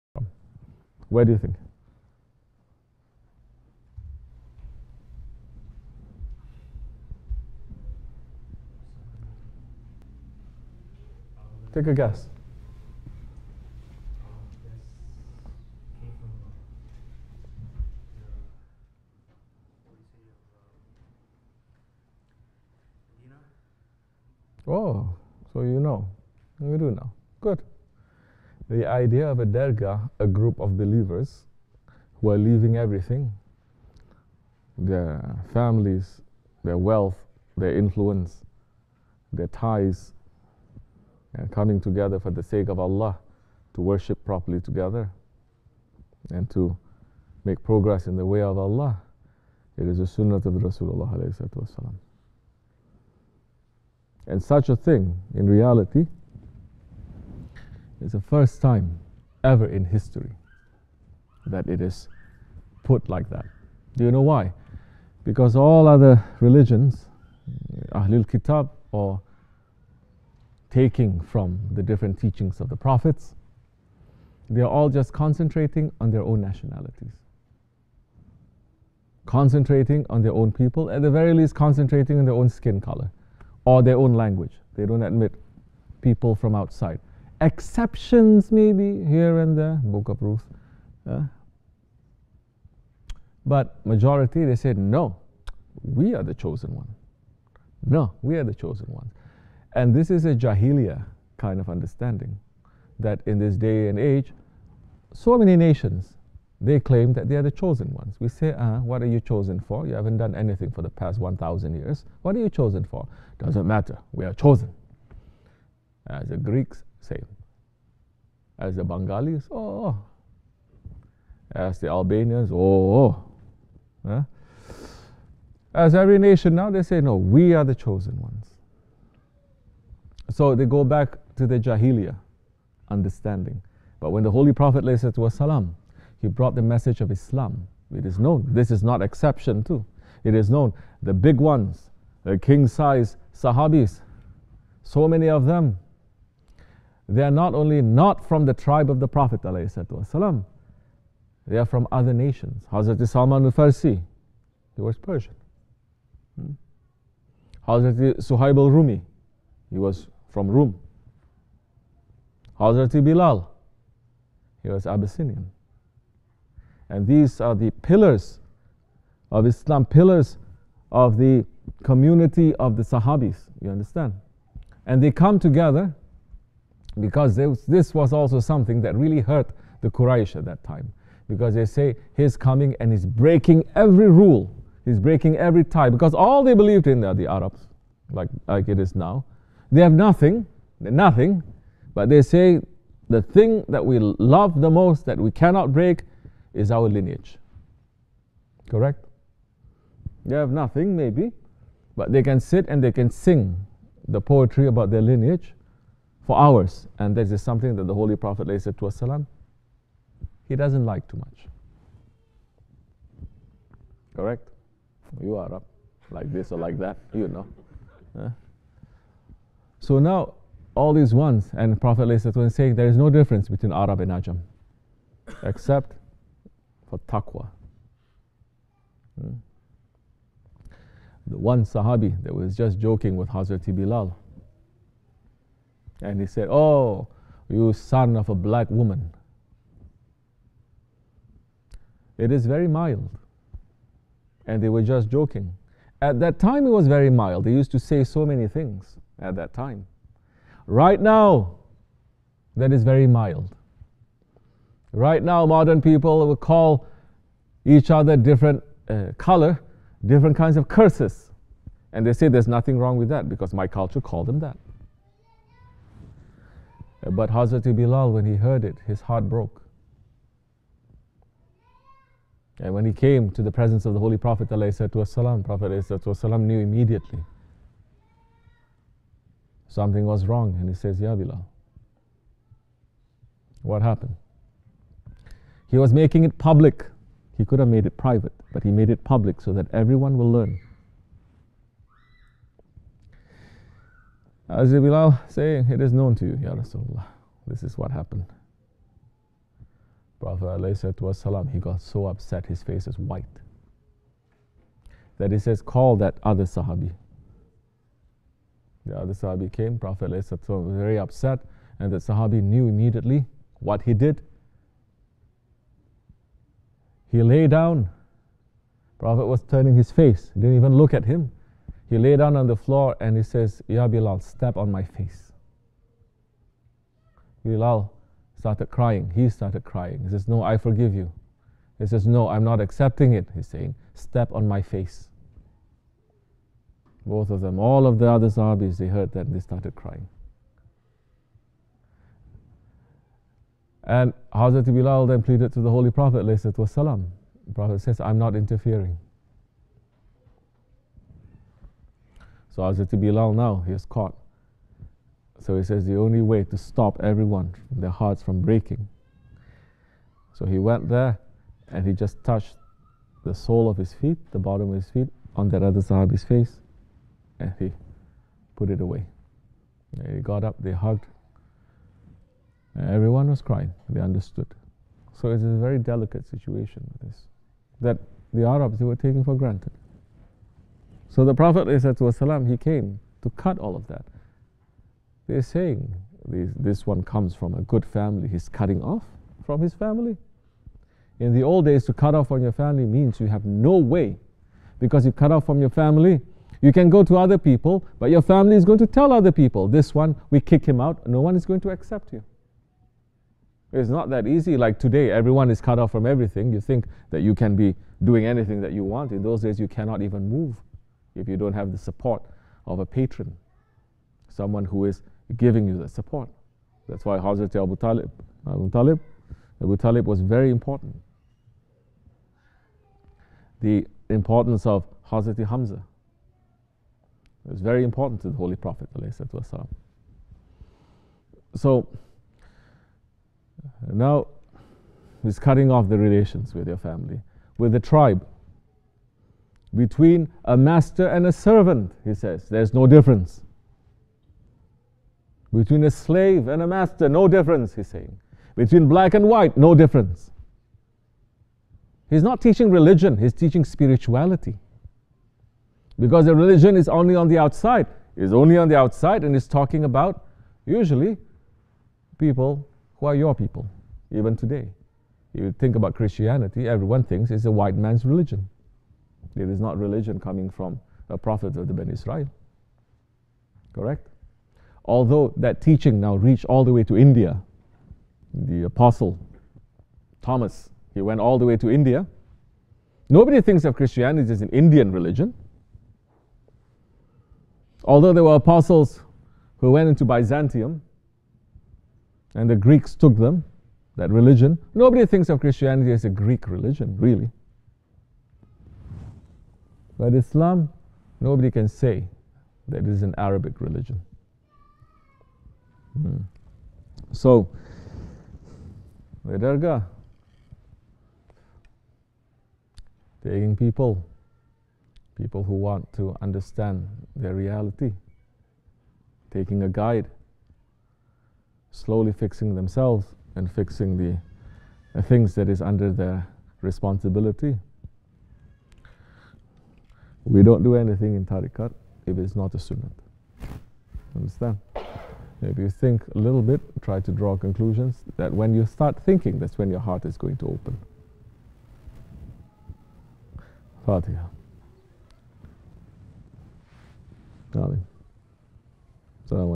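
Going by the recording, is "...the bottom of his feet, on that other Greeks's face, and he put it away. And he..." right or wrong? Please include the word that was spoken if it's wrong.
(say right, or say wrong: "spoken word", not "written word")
wrong: "Sahabi", not "Greeks".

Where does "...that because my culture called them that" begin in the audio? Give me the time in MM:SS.
04:23.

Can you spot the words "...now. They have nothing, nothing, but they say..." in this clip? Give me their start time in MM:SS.
03:08.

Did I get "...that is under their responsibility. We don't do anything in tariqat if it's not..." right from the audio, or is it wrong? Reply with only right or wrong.
right.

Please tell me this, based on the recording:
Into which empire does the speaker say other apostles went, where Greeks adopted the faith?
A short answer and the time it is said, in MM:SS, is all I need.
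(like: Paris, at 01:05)
Byzantium, at 08:10.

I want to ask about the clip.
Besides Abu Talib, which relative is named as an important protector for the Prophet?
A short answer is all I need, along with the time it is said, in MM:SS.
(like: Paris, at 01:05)
Hamza, at 07:05.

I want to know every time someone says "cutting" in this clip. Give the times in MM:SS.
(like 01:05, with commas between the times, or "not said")
06:28, 07:15.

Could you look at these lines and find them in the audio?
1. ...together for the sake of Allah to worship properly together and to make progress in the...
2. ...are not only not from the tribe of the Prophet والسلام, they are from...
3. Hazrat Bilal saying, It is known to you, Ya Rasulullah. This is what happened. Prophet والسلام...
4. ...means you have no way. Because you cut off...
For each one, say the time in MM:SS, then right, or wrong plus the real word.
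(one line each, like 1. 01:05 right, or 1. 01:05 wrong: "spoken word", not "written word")
1. 00:41 right
2. 02:27 right
3. 04:54 right
4. 06:32 right.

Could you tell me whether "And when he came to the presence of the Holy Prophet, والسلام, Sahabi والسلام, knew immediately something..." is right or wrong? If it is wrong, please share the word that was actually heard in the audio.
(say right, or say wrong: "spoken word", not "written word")
wrong: "Prophet", not "Sahabi".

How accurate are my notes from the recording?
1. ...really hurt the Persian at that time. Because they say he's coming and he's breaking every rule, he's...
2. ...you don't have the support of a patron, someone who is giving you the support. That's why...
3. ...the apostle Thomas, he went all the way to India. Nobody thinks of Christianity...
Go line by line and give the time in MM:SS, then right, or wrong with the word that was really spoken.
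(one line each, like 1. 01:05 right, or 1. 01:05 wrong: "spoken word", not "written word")
1. 02:58 wrong: "Quraysh", not "Persian"
2. 06:51 right
3. 07:58 right.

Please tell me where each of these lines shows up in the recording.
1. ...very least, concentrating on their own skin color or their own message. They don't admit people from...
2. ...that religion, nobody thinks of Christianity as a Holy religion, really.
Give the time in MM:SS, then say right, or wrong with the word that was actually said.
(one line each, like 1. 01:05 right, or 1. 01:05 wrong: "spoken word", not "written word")
1. 01:21 wrong: "language", not "message"
2. 08:13 wrong: "Greek", not "Holy".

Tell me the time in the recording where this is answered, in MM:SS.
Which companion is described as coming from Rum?
02:38.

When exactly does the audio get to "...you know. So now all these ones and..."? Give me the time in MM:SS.
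03:37.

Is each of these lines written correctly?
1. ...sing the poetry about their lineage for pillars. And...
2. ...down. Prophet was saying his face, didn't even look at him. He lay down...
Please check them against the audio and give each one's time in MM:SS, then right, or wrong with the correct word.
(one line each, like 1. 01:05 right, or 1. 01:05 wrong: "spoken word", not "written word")
1. 03:23 wrong: "hours", not "pillars"
2. 05:17 wrong: "turning", not "saying".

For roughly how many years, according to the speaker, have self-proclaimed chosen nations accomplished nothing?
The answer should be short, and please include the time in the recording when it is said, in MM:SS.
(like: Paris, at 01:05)
1,000, at 01:51.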